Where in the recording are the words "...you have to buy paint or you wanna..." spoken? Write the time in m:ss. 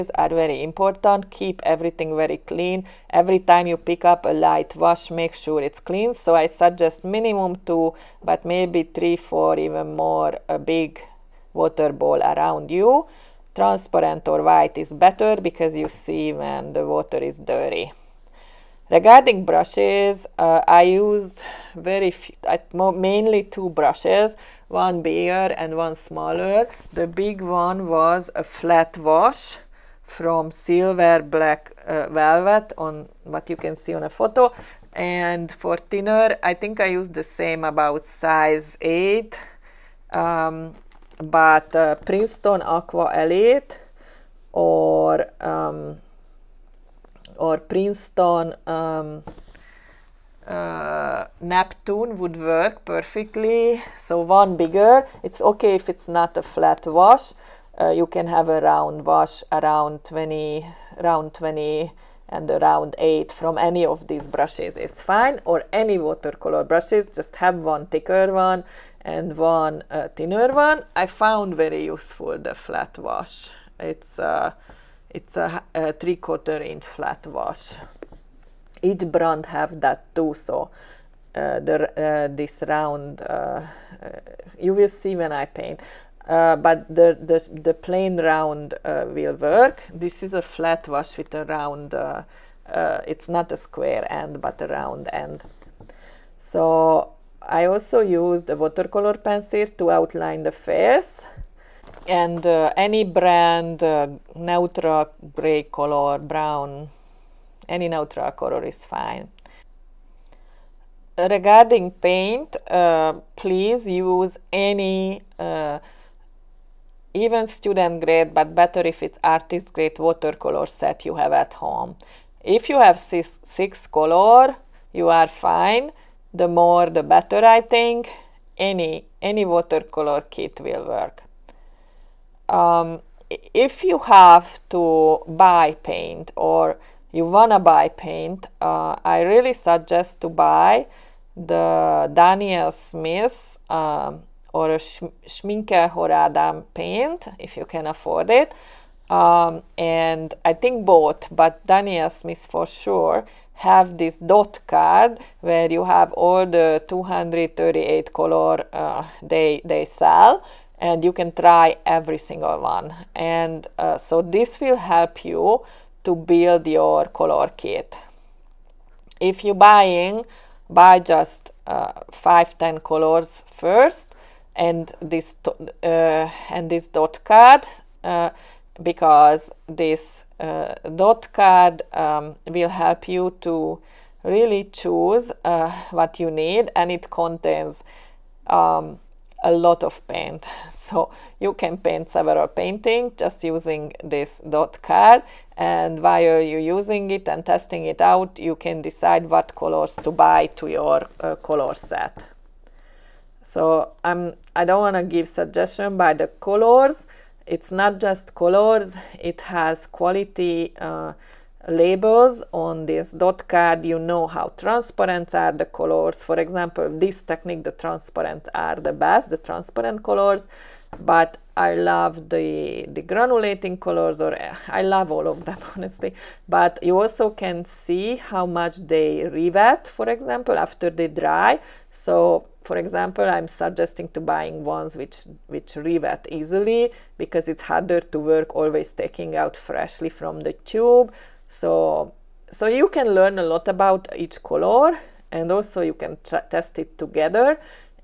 2:13.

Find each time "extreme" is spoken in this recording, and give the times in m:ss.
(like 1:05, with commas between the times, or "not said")
not said.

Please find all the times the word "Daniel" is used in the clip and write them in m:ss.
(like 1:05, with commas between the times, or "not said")
2:22, 2:31.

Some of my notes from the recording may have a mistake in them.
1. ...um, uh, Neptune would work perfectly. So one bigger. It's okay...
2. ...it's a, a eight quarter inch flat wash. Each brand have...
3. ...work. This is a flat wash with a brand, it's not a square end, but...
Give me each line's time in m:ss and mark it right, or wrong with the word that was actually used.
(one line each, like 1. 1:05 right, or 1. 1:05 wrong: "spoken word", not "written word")
1. 0:48 right
2. 1:15 wrong: "three", not "eight"
3. 1:29 wrong: "round", not "brand".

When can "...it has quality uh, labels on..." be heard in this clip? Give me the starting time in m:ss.
3:29.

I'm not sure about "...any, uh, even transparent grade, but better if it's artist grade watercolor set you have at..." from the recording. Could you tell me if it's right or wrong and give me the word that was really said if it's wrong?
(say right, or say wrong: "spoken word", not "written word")
wrong: "student", not "transparent".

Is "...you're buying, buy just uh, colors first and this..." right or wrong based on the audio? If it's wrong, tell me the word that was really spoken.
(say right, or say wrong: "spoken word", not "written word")
right.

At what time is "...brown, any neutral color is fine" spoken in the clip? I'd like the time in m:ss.
1:46.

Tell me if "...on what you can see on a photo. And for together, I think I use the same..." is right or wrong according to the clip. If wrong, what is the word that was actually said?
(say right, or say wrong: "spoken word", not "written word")
wrong: "thinner", not "together".